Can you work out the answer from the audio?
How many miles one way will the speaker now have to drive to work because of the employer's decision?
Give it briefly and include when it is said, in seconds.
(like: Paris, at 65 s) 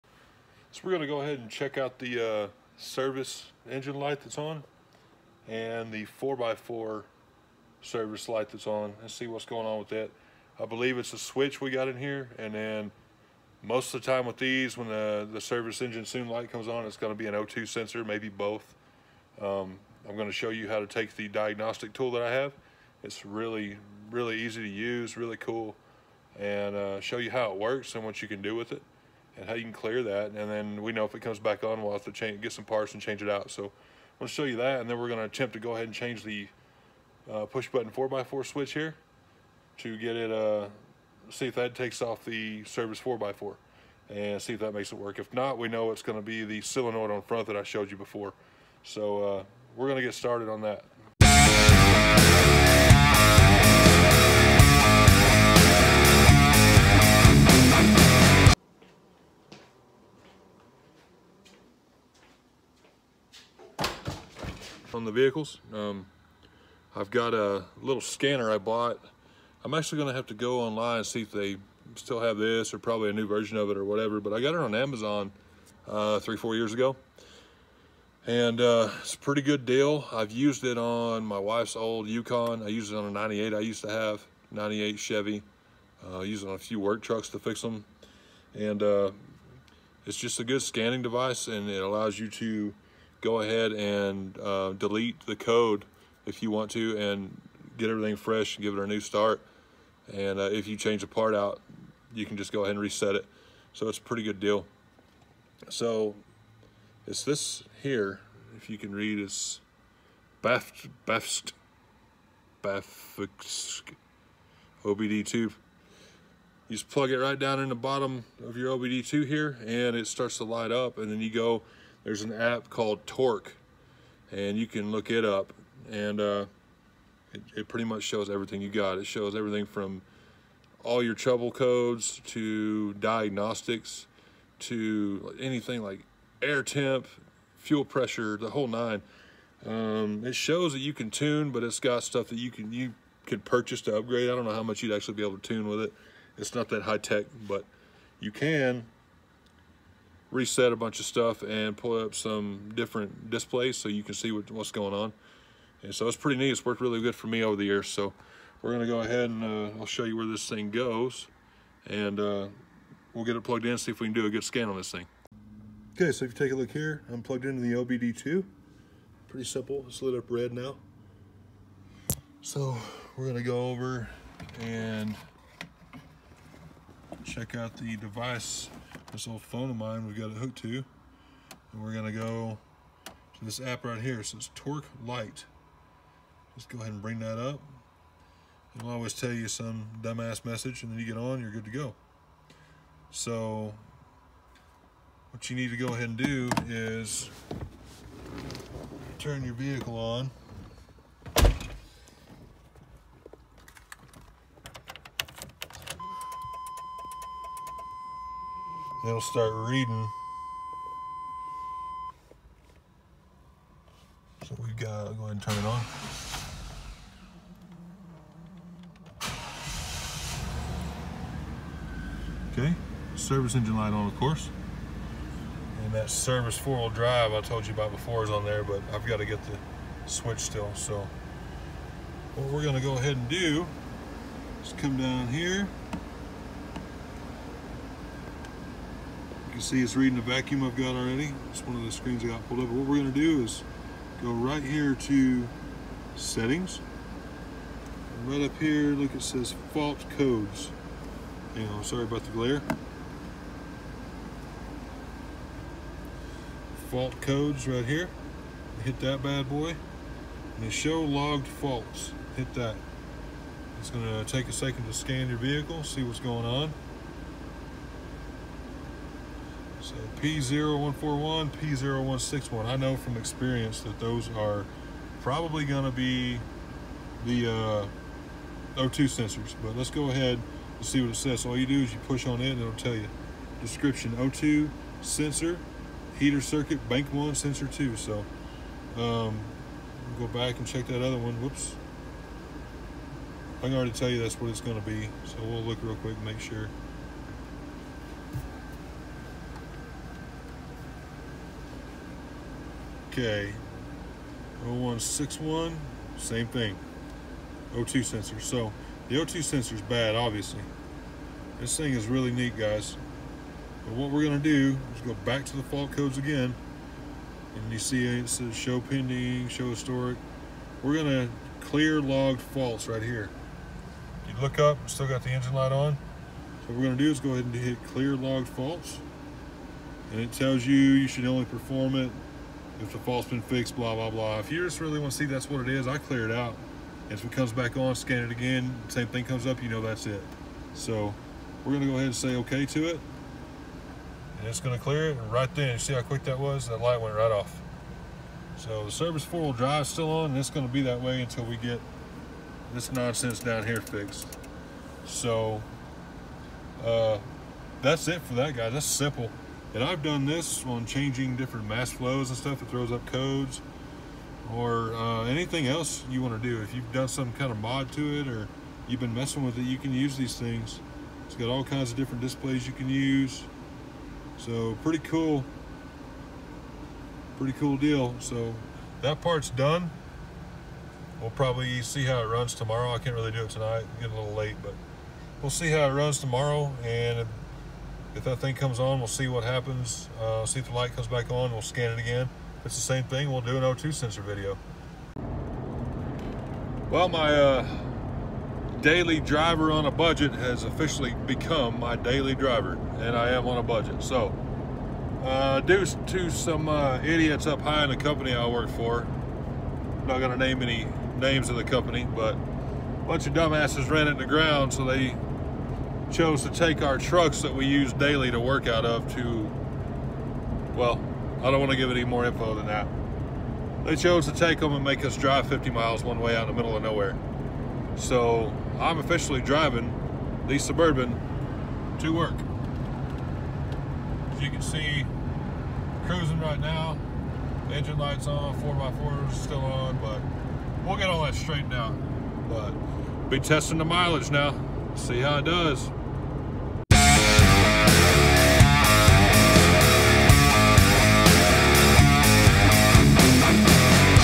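50 miles, at 425 s.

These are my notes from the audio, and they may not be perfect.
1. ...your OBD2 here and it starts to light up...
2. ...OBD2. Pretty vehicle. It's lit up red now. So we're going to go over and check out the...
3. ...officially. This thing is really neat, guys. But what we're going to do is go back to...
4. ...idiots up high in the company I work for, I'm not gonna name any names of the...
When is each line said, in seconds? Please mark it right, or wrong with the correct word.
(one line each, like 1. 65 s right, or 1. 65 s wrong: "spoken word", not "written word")
1. 118 s right
2. 167 s wrong: "simple", not "vehicle"
3. 310 s wrong: "obviously", not "officially"
4. 407 s right.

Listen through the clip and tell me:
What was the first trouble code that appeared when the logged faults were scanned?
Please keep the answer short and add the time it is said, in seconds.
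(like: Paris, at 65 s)
P0141, at 270 s.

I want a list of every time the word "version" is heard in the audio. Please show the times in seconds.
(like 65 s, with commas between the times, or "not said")
73 s.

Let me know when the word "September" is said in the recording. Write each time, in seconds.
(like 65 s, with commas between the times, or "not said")
not said.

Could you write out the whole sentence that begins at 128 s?
It shows everything from all your trouble codes to diagnostics to anything like air temp, fuel pressure, the whole nine.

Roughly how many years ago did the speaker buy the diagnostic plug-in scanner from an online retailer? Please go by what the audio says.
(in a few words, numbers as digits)
3 or 4 years.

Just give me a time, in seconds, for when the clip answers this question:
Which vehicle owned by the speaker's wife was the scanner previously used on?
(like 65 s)
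82 s.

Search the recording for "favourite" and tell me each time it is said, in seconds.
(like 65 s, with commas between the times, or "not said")
not said.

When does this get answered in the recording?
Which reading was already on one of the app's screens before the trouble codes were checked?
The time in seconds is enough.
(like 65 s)
240 s.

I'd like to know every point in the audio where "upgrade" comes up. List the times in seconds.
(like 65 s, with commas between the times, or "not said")
143 s.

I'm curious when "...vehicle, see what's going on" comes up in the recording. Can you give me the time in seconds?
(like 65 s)
265 s.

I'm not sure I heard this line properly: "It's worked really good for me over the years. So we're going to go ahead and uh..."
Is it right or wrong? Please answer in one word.
right.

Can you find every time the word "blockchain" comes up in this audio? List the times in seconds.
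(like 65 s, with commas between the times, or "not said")
not said.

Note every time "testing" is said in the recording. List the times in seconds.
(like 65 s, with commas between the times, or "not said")
443 s.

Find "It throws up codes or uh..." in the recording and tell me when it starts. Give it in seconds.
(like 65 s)
362 s.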